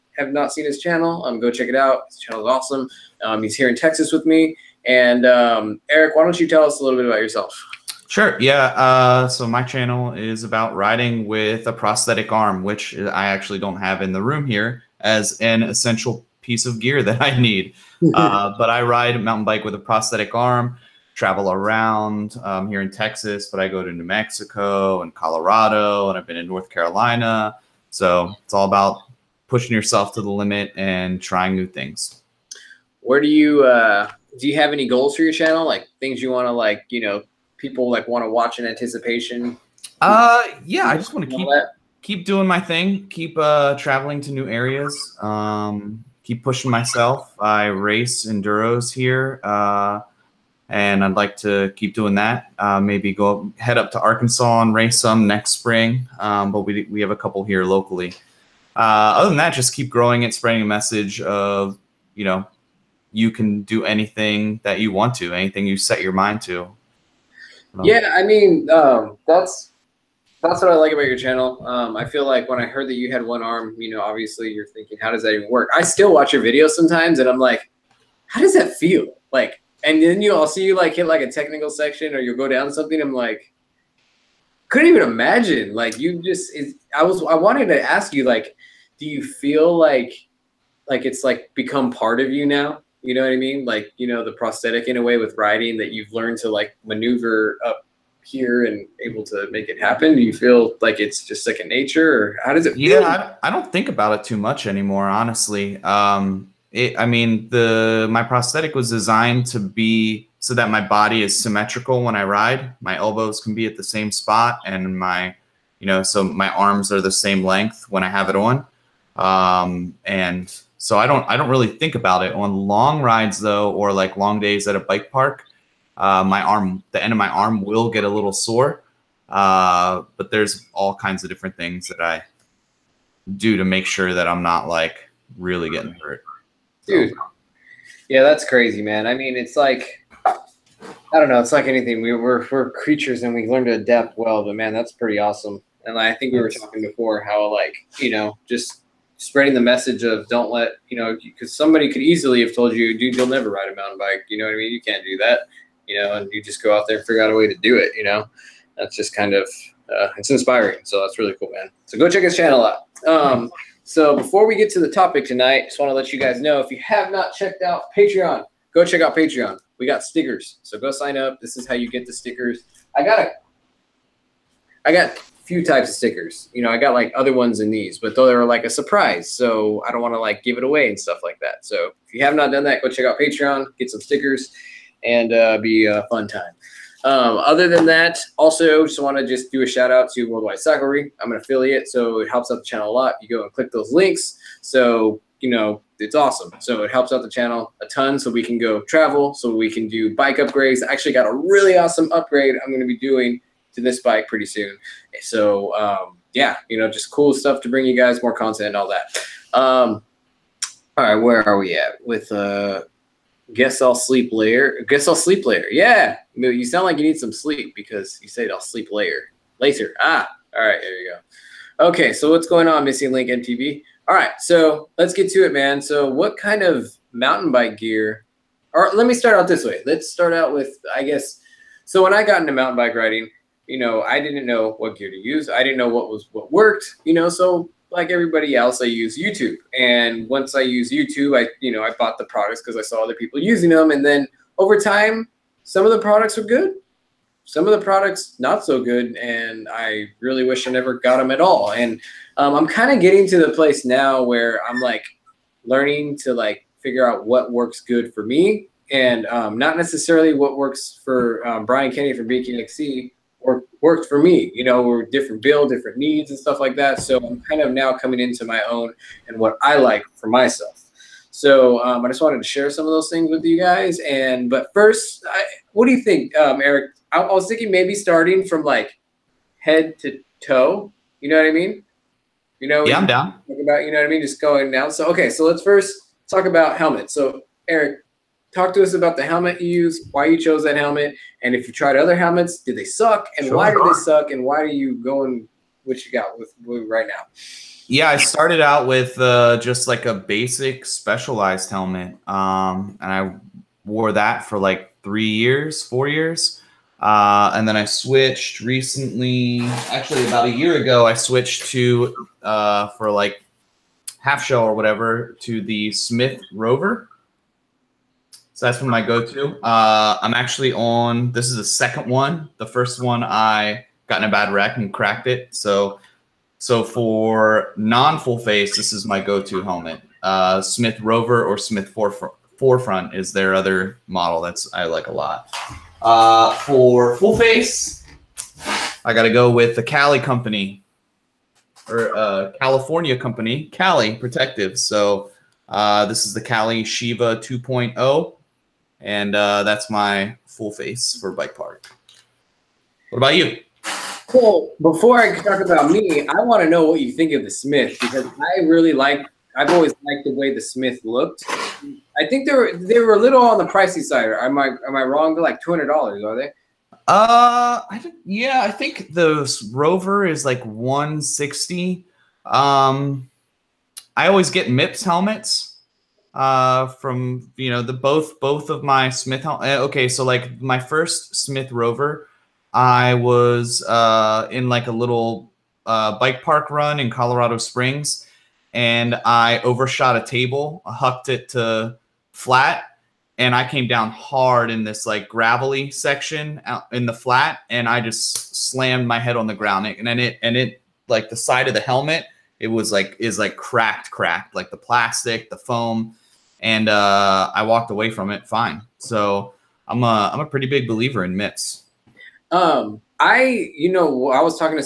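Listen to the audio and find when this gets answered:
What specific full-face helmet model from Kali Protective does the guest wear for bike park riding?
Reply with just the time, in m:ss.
5:46.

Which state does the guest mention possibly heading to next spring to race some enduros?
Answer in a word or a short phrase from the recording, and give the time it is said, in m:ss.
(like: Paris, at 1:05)
Arkansas, at 0:54.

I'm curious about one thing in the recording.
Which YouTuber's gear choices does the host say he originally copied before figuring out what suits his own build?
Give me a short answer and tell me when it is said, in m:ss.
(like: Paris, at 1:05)
Brian Kennedy, at 4:21.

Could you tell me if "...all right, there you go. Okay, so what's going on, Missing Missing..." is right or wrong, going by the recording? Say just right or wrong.
wrong.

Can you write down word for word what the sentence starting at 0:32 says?
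Where do you uh, do you have any goals for your channel?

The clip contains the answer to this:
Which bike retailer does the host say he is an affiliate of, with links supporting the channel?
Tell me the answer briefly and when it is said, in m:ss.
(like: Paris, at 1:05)
Worldwide Cyclery, at 3:10.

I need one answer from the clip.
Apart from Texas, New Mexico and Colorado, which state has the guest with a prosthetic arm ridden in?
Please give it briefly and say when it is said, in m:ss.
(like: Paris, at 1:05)
North Carolina, at 0:26.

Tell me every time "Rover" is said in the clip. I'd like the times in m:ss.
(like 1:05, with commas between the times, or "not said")
5:16, 5:30, 6:09, 6:21.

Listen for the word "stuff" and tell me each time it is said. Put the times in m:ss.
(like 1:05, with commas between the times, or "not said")
3:00, 3:27, 4:26.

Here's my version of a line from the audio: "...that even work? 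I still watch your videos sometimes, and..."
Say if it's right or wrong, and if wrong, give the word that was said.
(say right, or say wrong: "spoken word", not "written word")
right.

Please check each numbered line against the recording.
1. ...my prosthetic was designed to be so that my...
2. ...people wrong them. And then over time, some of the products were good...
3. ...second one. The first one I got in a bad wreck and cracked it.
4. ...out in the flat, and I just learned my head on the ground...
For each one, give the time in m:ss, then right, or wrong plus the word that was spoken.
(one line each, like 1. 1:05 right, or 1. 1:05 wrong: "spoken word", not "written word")
1. 1:48 right
2. 4:03 wrong: "using", not "wrong"
3. 5:21 right
4. 6:36 wrong: "slammed", not "learned".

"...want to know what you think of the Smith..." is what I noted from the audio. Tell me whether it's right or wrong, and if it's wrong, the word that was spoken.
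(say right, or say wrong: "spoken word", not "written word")
right.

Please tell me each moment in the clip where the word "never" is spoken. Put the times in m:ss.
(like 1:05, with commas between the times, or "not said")
2:33, 4:10.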